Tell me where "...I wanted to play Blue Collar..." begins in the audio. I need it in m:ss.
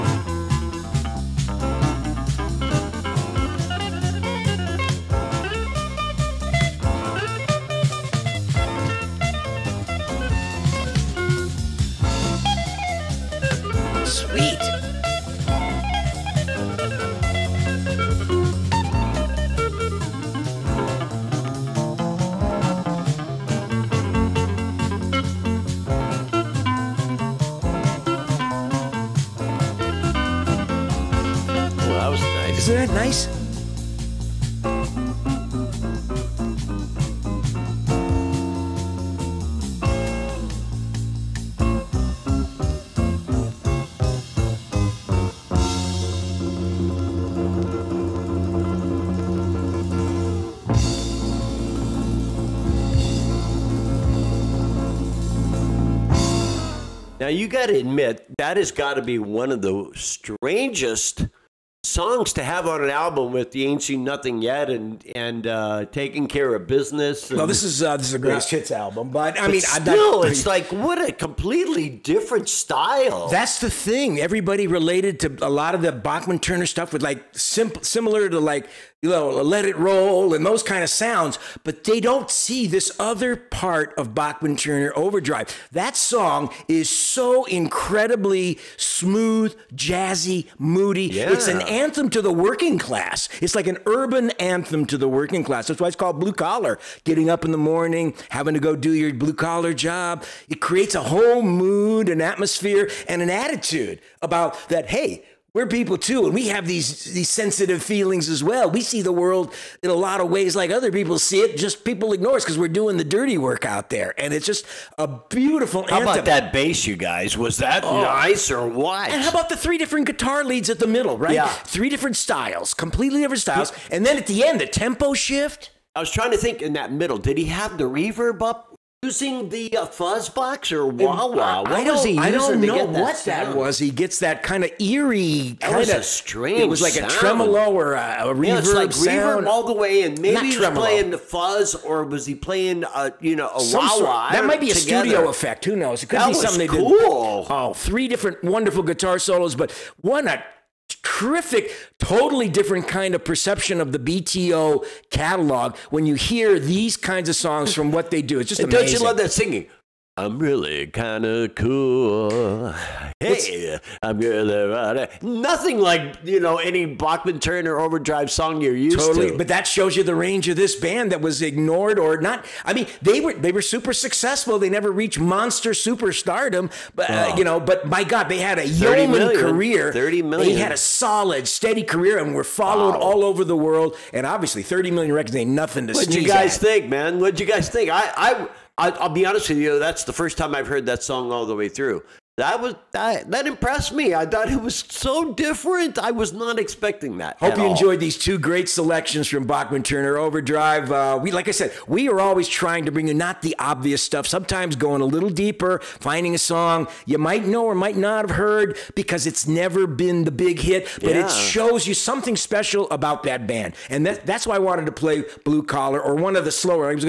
3:34.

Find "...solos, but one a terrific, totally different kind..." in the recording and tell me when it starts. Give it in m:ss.
2:29.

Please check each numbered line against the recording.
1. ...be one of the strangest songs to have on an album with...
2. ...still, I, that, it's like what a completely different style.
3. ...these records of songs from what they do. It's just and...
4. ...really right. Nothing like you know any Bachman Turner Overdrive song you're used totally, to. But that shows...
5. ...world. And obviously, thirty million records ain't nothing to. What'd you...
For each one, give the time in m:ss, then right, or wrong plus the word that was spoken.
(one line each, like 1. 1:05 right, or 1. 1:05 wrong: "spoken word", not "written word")
1. 0:59 right
2. 1:09 right
3. 2:36 wrong: "kinds", not "records"
4. 2:44 right
5. 3:03 right.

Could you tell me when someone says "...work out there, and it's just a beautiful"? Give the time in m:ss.
1:53.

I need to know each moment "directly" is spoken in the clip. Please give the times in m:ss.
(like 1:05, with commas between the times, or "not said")
not said.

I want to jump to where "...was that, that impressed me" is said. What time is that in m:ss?
3:12.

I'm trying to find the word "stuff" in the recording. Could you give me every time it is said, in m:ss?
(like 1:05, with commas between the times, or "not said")
1:16, 3:24.